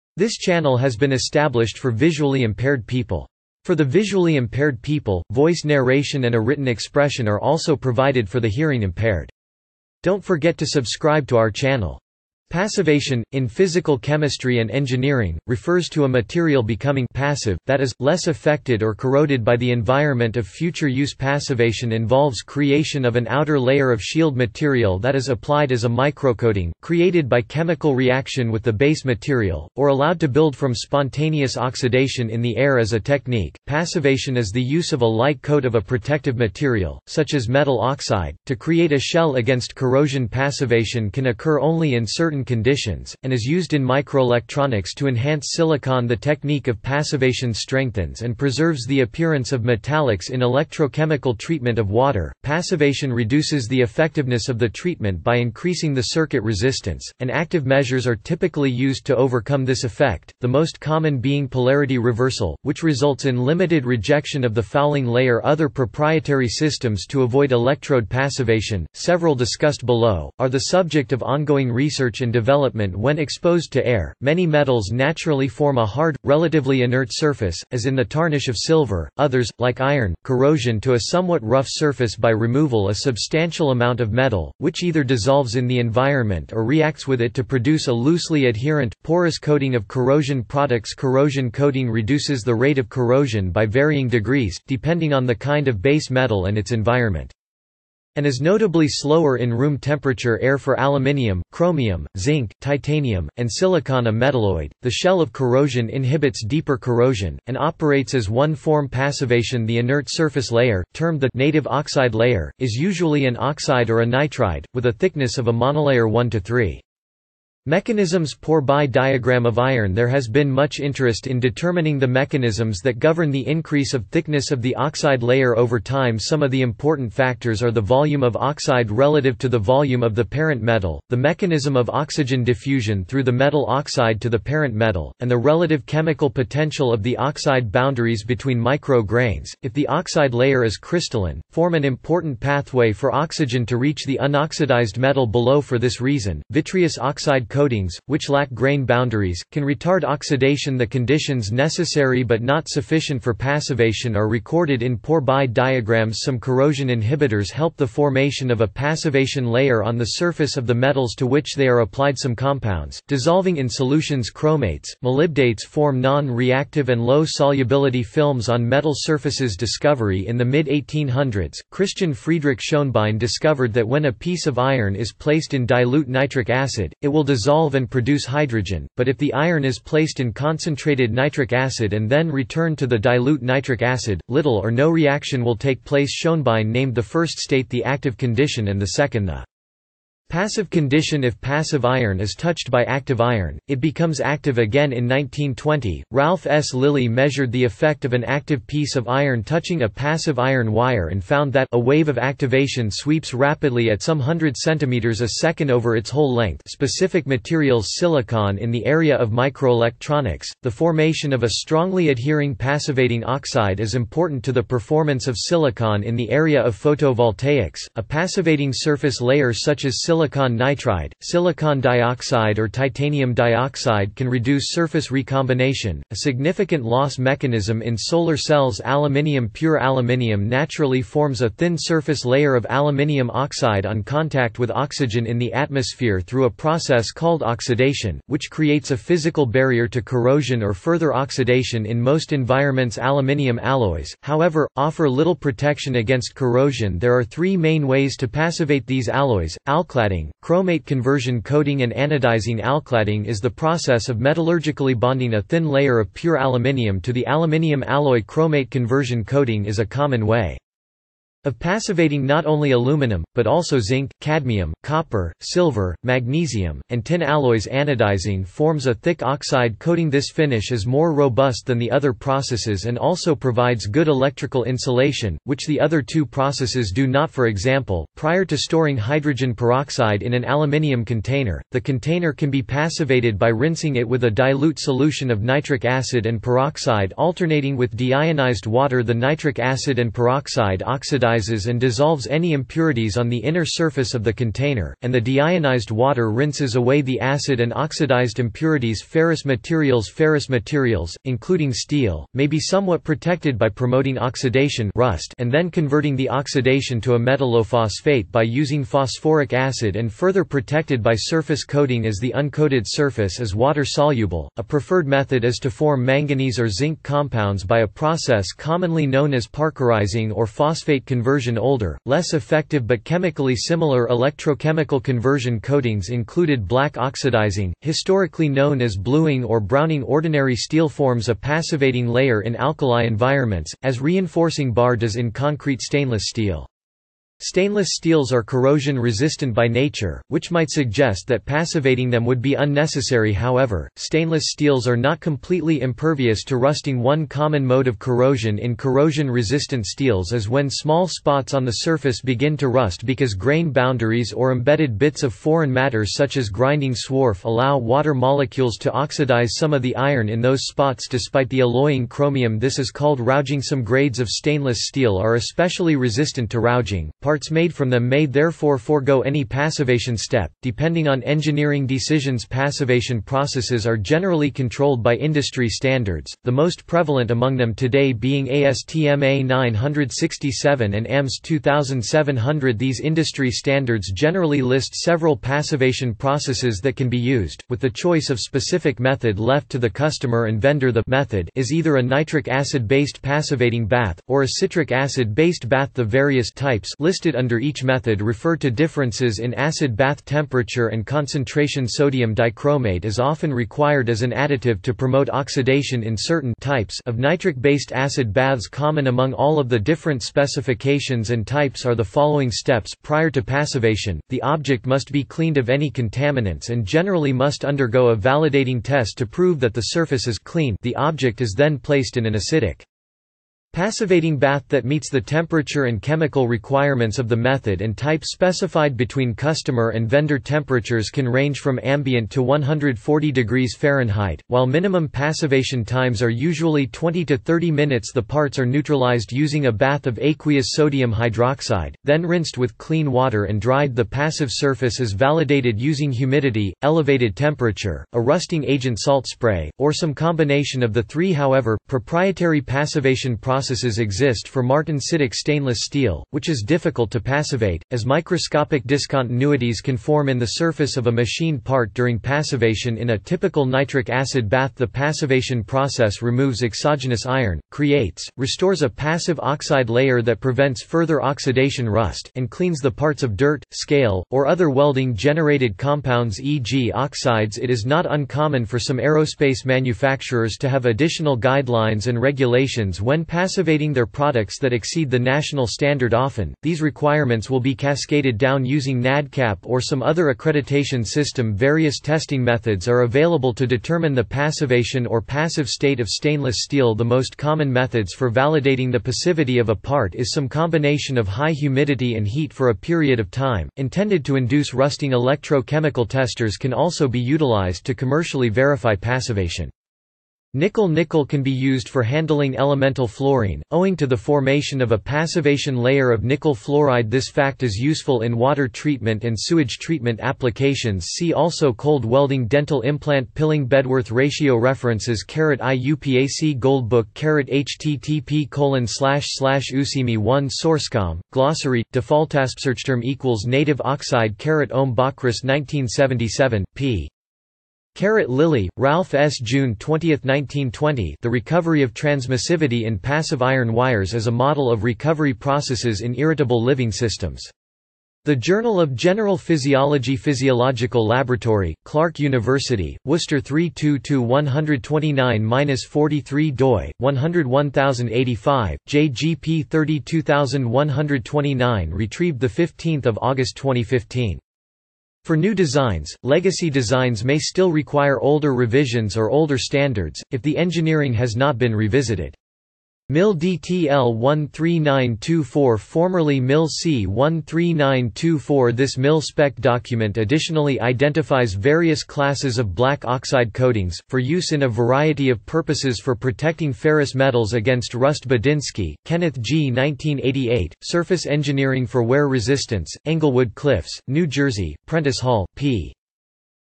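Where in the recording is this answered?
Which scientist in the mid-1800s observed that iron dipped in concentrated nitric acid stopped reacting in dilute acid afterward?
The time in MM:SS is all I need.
02:51.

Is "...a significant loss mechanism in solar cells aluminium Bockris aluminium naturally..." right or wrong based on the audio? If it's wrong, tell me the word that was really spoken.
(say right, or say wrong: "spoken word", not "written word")
wrong: "Pure", not "Bockris".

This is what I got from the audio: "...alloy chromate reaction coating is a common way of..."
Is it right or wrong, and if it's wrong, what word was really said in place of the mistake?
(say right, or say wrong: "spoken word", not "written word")
wrong: "conversion", not "reaction".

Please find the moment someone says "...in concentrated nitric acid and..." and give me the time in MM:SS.
03:00.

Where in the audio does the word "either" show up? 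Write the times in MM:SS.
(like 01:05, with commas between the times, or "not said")
01:24, 06:31.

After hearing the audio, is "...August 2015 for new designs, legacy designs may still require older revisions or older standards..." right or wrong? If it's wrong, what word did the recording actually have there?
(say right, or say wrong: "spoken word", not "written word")
right.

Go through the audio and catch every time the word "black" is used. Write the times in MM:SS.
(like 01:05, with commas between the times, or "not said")
05:26, 09:42.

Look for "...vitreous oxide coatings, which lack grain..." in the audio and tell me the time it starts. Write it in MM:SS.
02:26.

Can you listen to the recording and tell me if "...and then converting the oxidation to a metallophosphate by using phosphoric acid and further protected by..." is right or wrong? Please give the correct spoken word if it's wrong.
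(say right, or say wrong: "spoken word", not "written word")
right.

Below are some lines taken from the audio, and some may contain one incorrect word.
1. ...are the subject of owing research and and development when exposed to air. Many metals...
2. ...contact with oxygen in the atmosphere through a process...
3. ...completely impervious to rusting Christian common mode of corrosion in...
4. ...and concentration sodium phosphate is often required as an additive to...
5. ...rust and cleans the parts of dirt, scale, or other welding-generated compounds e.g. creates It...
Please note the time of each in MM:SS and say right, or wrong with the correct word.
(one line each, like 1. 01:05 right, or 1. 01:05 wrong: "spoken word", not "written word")
1. 01:10 wrong: "ongoing", not "owing"
2. 03:54 right
3. 05:45 wrong: "One", not "Christian"
4. 06:40 wrong: "dichromate", not "phosphate"
5. 07:51 wrong: "oxides", not "creates".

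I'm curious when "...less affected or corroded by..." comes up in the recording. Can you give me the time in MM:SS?
00:18.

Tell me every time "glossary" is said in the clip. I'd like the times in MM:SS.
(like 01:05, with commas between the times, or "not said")
08:51.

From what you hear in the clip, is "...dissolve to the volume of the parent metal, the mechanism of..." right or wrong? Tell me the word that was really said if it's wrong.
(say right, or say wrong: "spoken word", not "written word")
wrong: "relative", not "dissolve".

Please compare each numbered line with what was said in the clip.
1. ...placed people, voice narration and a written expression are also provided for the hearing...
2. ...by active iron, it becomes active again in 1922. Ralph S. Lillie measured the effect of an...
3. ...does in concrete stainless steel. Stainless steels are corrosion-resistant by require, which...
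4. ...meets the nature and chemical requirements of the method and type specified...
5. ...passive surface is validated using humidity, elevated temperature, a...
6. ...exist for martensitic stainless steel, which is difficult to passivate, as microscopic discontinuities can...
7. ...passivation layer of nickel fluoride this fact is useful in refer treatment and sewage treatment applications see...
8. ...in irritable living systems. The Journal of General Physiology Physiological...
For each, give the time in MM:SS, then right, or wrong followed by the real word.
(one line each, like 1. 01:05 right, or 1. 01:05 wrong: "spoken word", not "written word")
1. 00:04 wrong: "impaired", not "placed"
2. 03:12 wrong: "1920", not "1922"
3. 05:34 wrong: "nature", not "require"
4. 07:04 wrong: "temperature", not "nature"
5. 07:24 right
6. 07:33 right
7. 08:34 wrong: "water", not "refer"
8. 09:05 right.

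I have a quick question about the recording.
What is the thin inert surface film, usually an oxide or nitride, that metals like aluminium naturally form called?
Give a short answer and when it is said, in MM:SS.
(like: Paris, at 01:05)
native oxide layer, at 01:51.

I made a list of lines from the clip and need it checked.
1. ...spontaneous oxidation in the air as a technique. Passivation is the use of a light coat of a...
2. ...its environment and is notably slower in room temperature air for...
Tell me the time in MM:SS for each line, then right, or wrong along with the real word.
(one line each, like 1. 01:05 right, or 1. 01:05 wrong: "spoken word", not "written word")
1. 00:30 right
2. 01:36 right.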